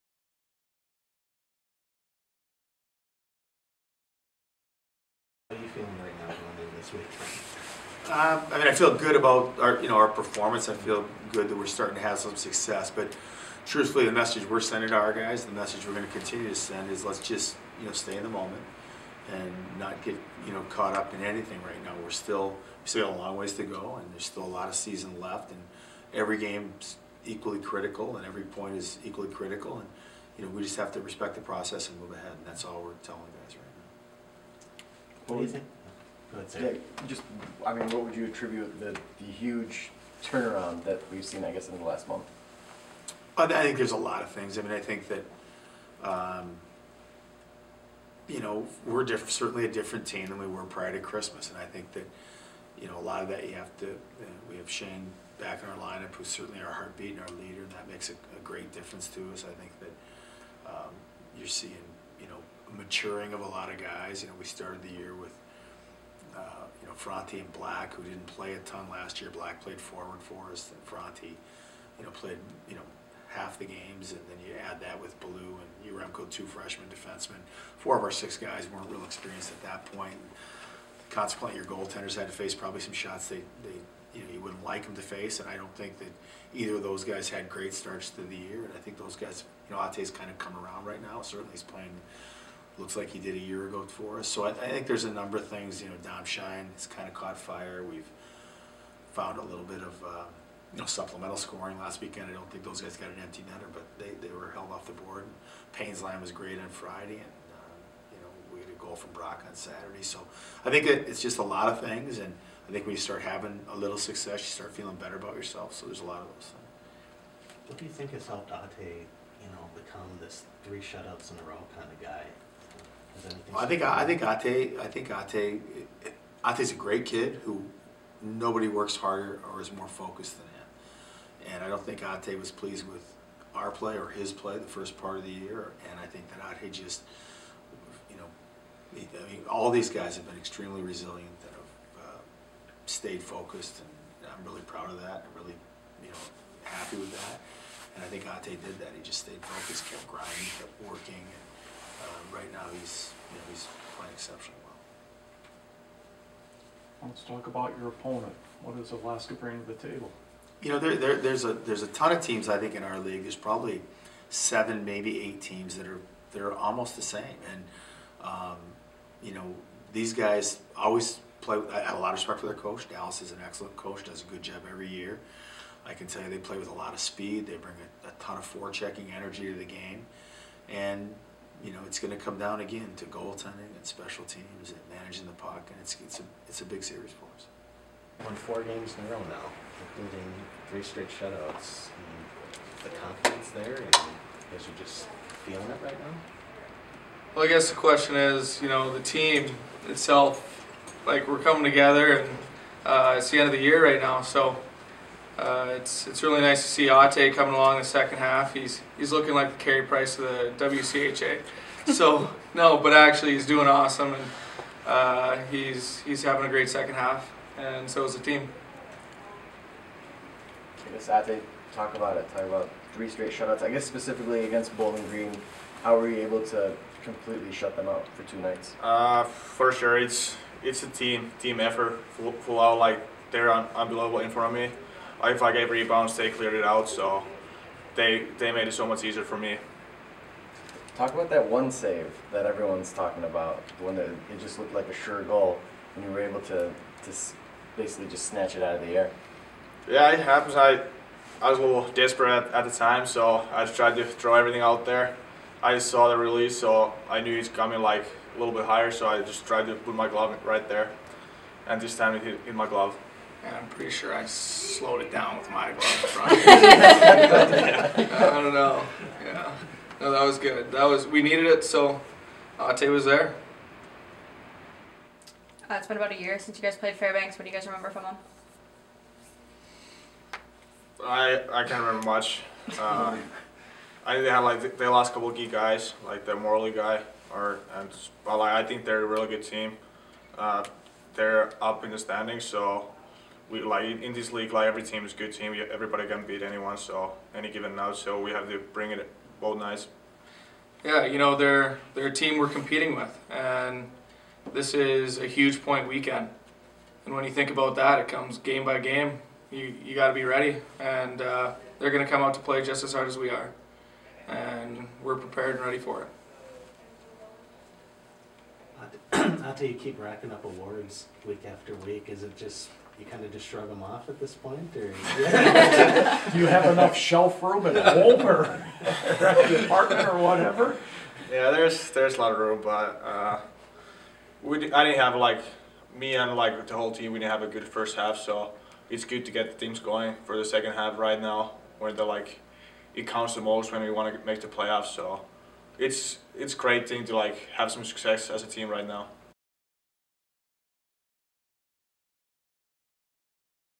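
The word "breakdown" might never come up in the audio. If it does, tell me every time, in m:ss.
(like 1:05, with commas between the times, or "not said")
not said.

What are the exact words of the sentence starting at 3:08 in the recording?
Won four games in a row now, including three straight shutouts.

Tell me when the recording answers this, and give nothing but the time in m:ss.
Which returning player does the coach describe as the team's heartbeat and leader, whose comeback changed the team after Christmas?
0:54.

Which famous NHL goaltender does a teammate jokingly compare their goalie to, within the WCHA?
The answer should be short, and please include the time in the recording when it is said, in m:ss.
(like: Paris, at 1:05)
Carey Price, at 3:29.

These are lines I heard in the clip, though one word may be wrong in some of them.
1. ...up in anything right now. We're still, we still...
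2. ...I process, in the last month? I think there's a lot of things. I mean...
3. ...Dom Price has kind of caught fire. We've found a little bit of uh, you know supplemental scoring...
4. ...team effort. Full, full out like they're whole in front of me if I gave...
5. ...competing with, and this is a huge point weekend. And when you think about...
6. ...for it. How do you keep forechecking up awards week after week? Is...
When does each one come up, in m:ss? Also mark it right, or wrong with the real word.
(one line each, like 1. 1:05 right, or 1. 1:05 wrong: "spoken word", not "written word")
1. 0:20 right
2. 0:41 wrong: "guess", not "process"
3. 1:36 wrong: "Shine", not "Price"
4. 3:51 wrong: "unbelievable", not "whole"
5. 5:02 right
6. 5:15 wrong: "racking", not "forechecking".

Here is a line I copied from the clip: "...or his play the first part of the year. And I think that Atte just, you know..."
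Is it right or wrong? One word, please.
right.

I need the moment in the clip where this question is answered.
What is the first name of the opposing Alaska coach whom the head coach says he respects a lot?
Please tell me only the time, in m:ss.
2:52.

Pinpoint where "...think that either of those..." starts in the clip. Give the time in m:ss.
1:25.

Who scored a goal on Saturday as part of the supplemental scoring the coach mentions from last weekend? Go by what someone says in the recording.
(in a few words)
Brock.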